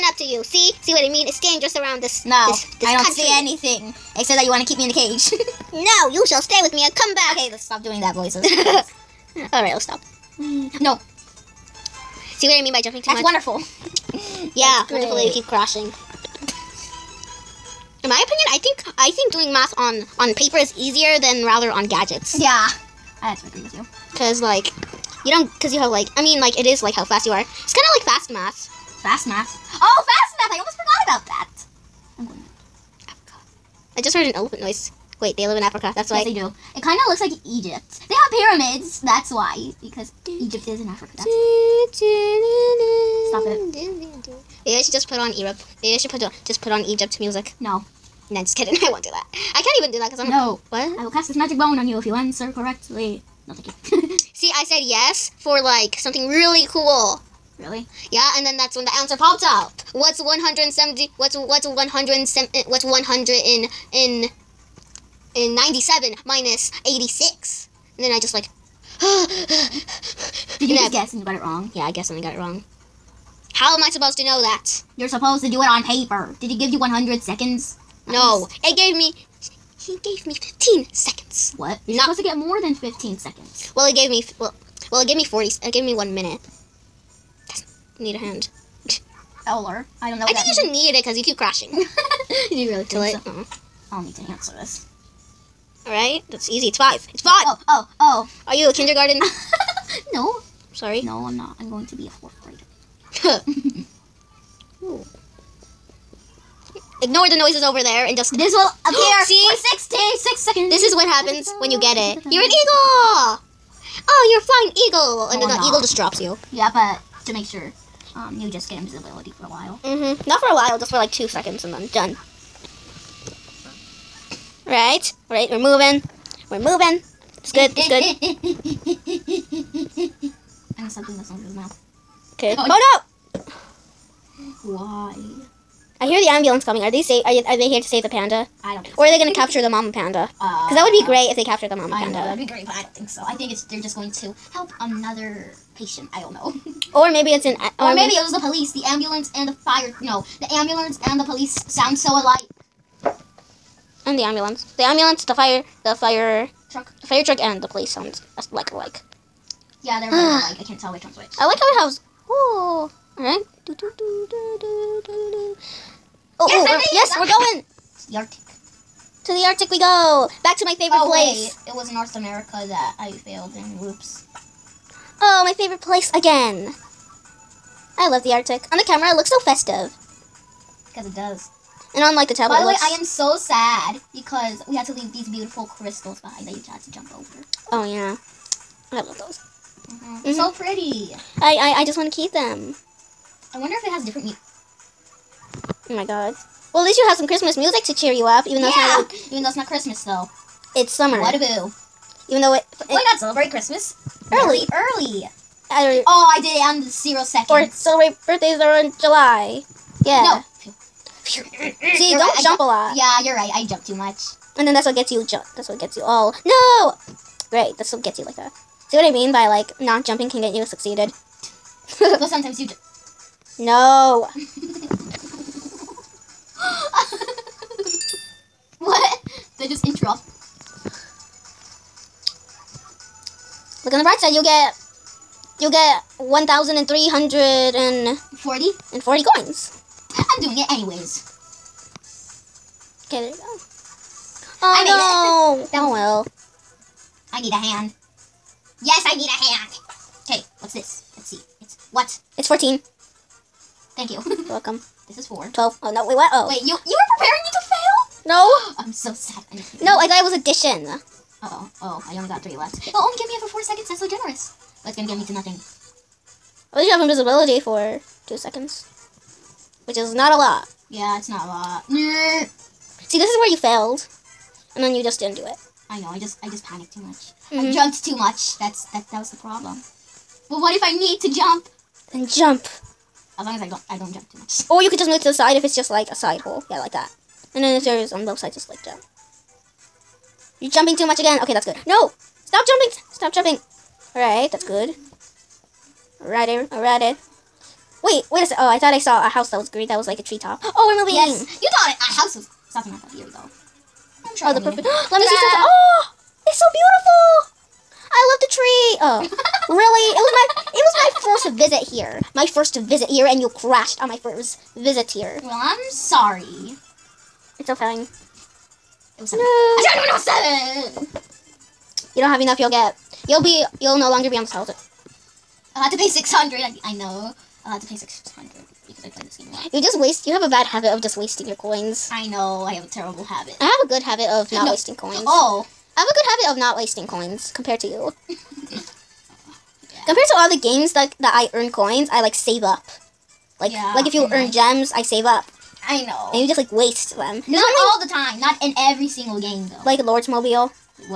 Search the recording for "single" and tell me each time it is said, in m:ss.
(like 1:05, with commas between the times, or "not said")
5:49.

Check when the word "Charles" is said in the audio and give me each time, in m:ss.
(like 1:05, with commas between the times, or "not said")
not said.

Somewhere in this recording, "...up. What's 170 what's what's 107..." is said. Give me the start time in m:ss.
0:59.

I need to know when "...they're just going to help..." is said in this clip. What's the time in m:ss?
2:23.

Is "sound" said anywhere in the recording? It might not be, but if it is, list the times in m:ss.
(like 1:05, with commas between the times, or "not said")
2:31, 2:37.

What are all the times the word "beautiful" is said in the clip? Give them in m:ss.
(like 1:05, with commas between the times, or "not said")
3:05, 5:06.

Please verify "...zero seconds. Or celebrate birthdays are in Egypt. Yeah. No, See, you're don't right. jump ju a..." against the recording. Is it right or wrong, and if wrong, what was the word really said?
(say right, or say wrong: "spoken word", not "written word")
wrong: "July", not "Egypt".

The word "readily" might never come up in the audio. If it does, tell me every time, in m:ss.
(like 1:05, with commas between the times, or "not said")
not said.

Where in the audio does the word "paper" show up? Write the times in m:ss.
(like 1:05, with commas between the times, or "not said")
0:20, 1:15.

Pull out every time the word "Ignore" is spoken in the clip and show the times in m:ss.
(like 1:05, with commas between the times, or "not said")
1:47.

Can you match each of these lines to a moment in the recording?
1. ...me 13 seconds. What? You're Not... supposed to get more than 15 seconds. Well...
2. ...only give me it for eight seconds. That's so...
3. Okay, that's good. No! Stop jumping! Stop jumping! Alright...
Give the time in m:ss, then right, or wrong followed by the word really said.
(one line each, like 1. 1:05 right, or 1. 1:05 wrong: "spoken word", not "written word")
1. 1:20 wrong: "15", not "13"
2. 4:22 wrong: "four", not "eight"
3. 4:51 right.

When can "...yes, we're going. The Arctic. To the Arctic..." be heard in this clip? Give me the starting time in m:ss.
2:46.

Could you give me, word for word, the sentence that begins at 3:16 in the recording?
Well, at least you have some Christmas music to cheer you up, even though yeah.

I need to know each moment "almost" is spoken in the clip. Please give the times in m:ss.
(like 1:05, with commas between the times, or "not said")
0:30.